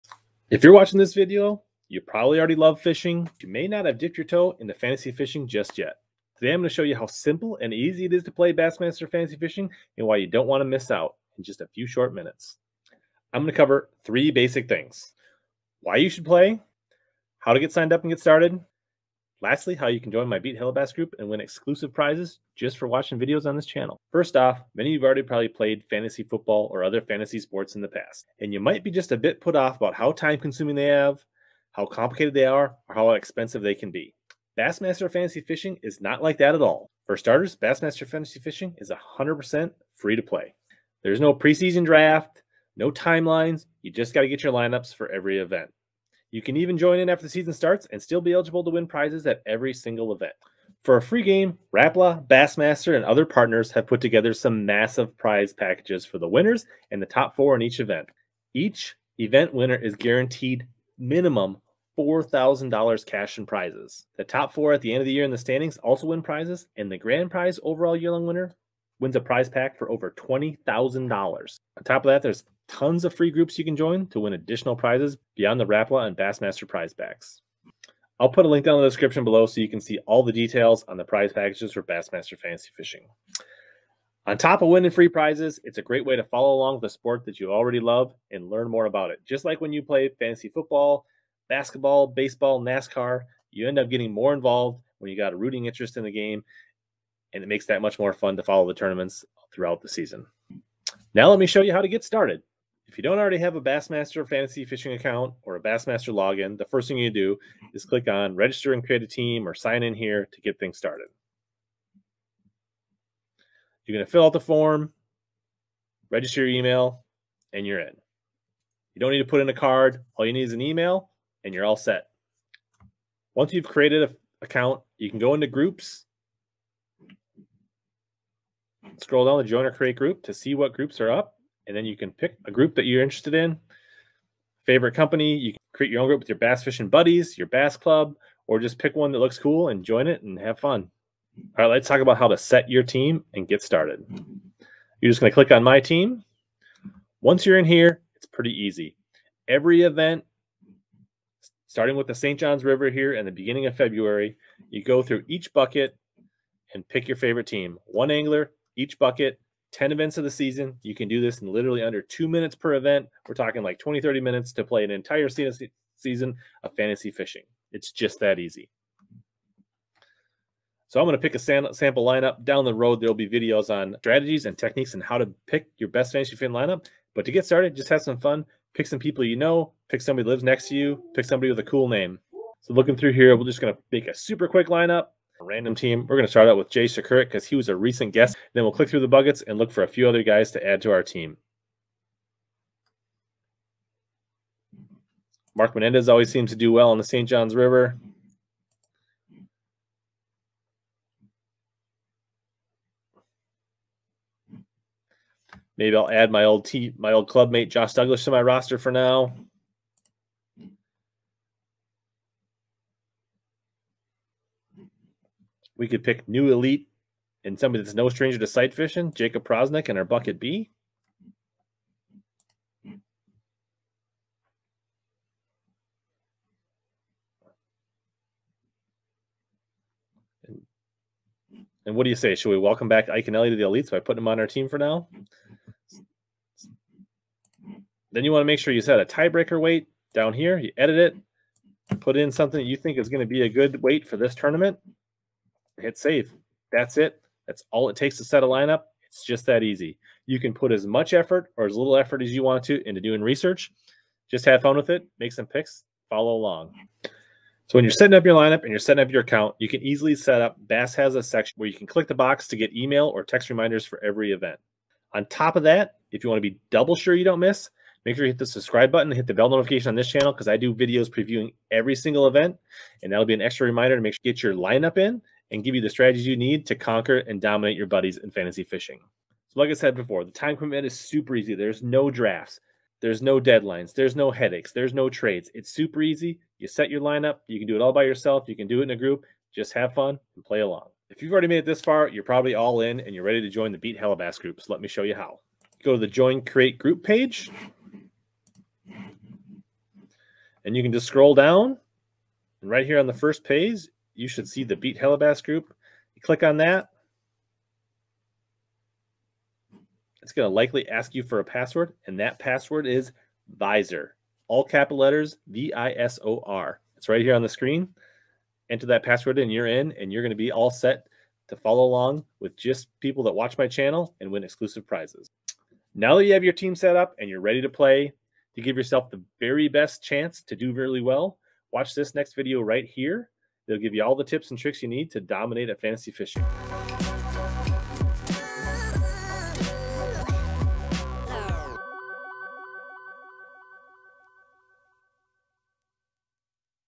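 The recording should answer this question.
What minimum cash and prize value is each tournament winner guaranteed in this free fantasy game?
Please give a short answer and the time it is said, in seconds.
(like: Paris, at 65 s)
$4,000, at 61 s.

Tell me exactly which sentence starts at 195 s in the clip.
Mark Menendez always seems to do well on the St.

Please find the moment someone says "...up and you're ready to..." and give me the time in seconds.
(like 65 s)
326 s.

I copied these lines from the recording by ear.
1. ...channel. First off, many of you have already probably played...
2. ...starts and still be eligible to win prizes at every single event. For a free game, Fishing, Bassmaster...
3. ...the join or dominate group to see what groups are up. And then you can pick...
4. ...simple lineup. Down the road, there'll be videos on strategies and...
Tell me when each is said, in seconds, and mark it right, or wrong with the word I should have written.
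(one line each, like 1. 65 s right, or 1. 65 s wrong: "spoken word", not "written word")
1. 23 s right
2. 47 s wrong: "Rapala", not "Fishing"
3. 129 s wrong: "create", not "dominate"
4. 171 s wrong: "sample", not "simple".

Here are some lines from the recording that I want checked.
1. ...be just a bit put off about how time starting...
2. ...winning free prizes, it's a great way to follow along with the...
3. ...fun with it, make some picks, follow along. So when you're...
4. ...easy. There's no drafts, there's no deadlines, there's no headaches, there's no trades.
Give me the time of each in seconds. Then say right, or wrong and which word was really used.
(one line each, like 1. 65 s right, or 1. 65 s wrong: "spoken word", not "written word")
1. 28 s wrong: "consuming", not "starting"
2. 84 s right
3. 254 s right
4. 281 s right.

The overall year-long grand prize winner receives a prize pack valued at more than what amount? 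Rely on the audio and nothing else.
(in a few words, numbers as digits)
$20,000.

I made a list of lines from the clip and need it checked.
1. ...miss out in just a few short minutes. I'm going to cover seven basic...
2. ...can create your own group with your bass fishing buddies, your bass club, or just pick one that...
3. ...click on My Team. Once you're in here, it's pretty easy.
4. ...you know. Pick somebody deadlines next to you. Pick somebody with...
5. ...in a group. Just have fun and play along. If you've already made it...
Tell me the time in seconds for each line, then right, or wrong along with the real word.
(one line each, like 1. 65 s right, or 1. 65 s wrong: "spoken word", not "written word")
1. 10 s wrong: "three", not "seven"
2. 135 s right
3. 145 s right
4. 179 s wrong: "lives", not "deadlines"
5. 288 s right.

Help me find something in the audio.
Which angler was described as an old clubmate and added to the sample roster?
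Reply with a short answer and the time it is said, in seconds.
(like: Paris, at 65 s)
Josh Douglas, at 207 s.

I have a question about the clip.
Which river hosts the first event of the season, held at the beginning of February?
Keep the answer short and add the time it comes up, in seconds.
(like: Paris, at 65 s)
St. John's River, at 152 s.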